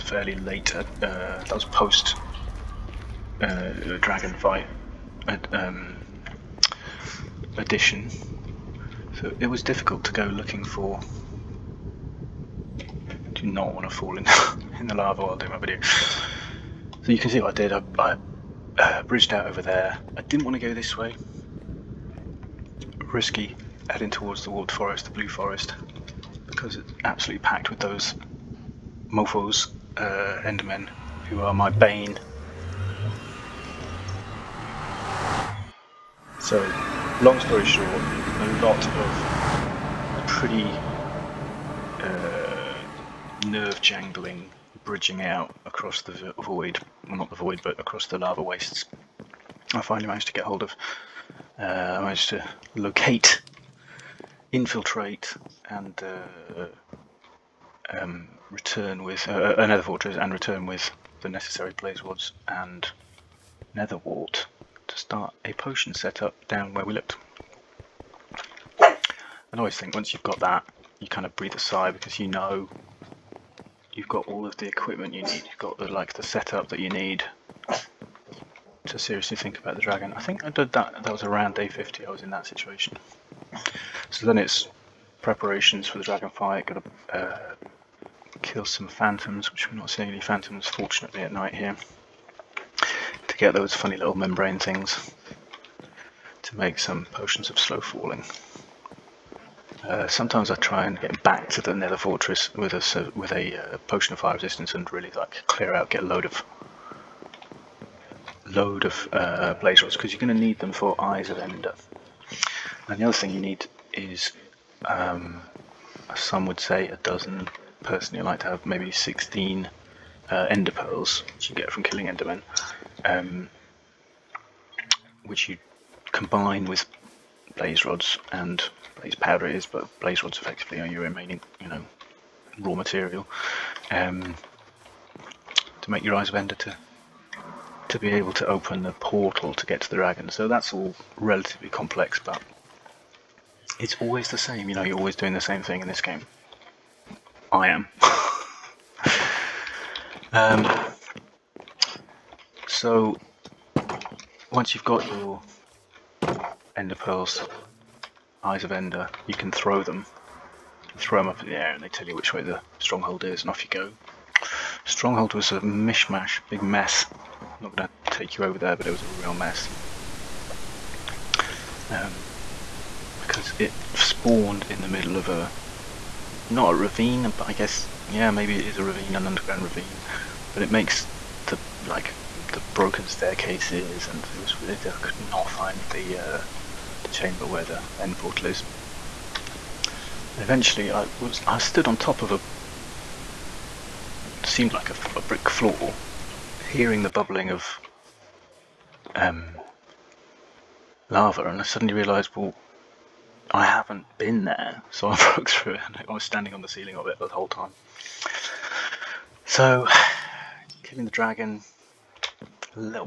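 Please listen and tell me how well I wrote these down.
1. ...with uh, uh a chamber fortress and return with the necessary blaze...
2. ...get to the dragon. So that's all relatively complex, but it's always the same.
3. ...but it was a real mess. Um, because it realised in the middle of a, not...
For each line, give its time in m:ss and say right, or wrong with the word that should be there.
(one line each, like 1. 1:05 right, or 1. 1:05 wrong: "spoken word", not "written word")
1. 0:59 wrong: "nether", not "chamber"
2. 2:19 right
3. 2:48 wrong: "spawned", not "realised".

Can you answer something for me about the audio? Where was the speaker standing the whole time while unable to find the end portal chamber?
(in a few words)
On the ceiling.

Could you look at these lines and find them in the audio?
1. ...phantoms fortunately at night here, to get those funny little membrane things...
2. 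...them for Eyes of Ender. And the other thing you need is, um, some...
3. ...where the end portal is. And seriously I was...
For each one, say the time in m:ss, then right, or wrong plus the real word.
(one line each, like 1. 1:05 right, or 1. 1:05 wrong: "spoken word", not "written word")
1. 1:30 right
2. 1:50 right
3. 3:07 wrong: "eventually", not "seriously".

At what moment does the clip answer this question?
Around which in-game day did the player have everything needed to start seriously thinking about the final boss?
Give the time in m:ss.
1:21.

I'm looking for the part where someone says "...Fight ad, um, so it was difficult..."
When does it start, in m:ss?
0:04.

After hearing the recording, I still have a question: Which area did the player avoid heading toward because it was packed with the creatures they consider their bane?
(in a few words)
Warped Forest.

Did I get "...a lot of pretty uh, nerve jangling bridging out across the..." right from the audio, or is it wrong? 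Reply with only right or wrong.
right.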